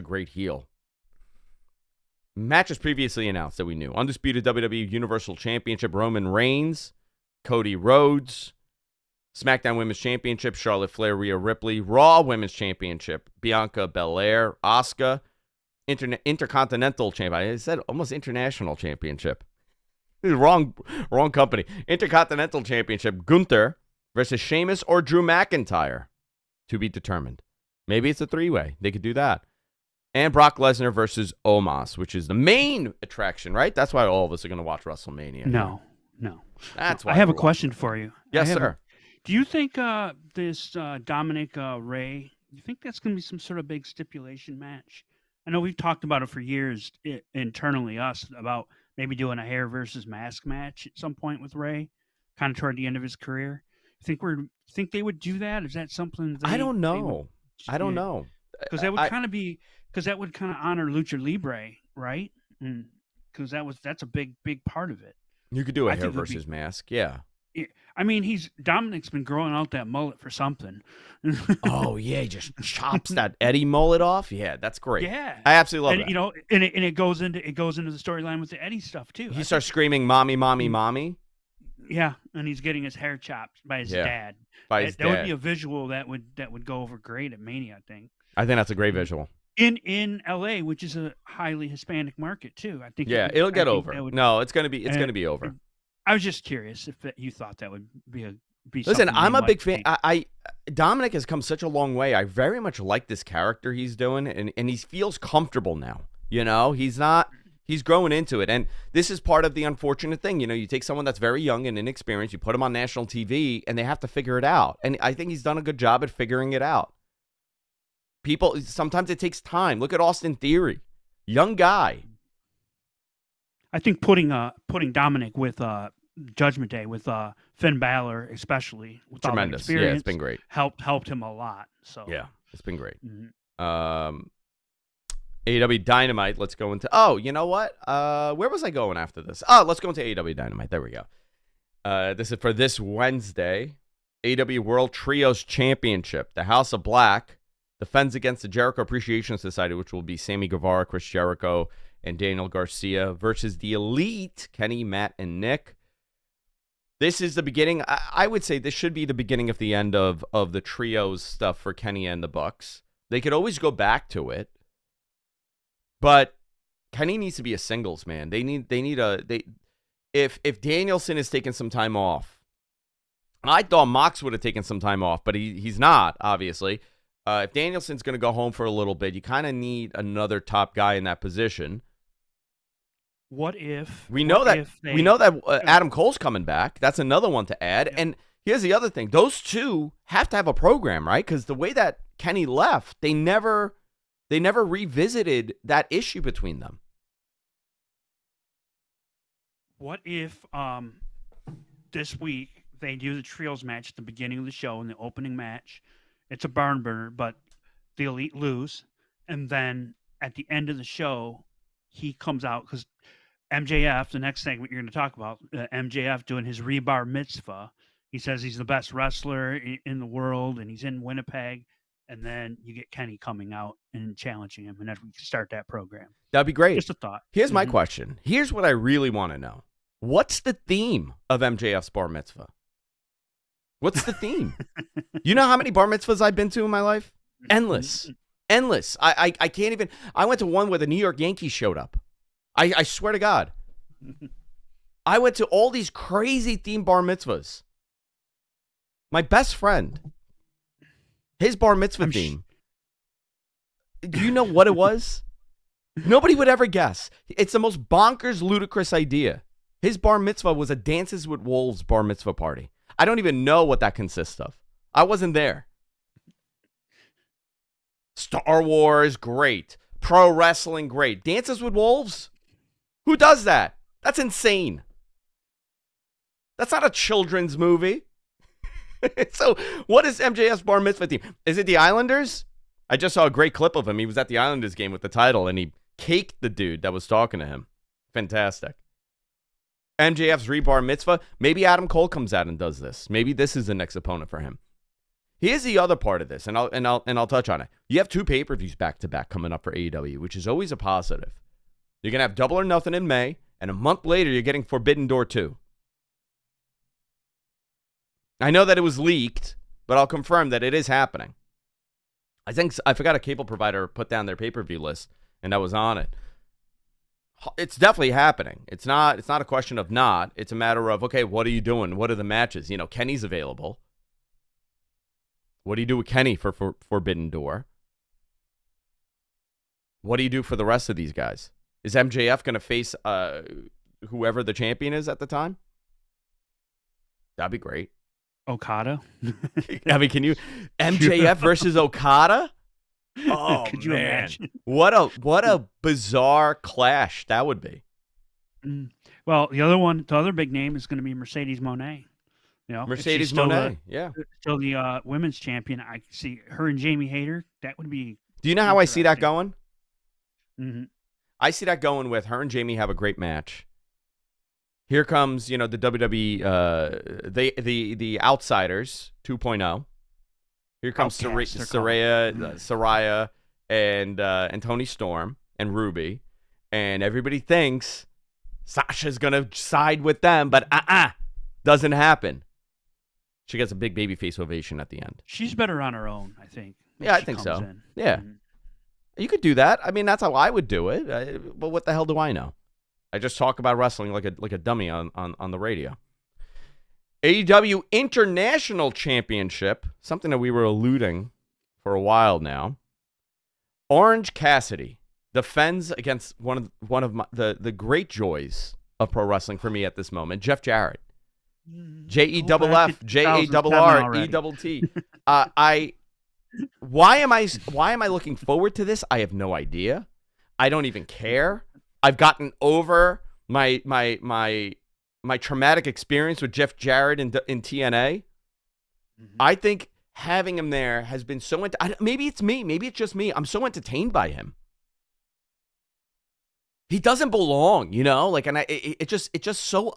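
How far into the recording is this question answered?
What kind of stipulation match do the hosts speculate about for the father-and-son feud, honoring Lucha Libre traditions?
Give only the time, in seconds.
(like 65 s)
49 s.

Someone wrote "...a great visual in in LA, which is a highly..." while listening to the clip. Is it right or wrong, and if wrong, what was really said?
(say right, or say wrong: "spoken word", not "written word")
right.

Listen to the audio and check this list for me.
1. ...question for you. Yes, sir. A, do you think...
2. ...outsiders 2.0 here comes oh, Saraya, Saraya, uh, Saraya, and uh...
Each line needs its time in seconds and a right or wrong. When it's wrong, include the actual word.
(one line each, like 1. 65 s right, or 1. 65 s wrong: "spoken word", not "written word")
1. 37 s right
2. 368 s right.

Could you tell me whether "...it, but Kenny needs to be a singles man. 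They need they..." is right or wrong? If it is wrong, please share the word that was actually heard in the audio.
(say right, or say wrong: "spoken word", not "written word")
right.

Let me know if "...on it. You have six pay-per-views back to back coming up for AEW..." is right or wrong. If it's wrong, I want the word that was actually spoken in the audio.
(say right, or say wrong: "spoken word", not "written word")
wrong: "two", not "six".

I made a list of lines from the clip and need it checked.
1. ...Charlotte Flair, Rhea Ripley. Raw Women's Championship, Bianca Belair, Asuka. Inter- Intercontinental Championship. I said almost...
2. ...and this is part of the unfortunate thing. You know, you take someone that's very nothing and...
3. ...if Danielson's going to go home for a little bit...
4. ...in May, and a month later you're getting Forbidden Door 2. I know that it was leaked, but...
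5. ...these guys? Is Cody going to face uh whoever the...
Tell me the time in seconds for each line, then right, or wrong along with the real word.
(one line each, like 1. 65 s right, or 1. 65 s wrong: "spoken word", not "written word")
1. 10 s right
2. 108 s wrong: "young", not "nothing"
3. 177 s right
4. 302 s right
5. 330 s wrong: "MJF", not "Cody".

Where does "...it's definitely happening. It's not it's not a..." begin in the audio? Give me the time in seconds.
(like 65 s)
317 s.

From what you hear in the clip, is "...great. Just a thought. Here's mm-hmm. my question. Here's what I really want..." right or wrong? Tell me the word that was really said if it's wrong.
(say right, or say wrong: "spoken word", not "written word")
right.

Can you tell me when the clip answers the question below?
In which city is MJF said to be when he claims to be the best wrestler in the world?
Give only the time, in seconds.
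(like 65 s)
221 s.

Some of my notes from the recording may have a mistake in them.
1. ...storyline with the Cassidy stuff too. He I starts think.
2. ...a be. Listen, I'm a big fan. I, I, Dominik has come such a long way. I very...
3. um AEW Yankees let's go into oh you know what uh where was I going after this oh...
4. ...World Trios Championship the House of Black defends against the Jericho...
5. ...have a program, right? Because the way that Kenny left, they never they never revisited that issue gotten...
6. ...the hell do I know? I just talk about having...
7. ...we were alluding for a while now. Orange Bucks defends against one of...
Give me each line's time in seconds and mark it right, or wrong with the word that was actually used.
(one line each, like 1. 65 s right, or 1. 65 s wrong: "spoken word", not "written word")
1. 77 s wrong: "Eddie", not "Cassidy"
2. 98 s right
3. 133 s wrong: "Dynamite", not "Yankees"
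4. 144 s right
5. 190 s wrong: "between", not "gotten"
6. 391 s wrong: "wrestling", not "having"
7. 400 s wrong: "Cassidy", not "Bucks".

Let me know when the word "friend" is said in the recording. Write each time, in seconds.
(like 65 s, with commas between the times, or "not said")
249 s.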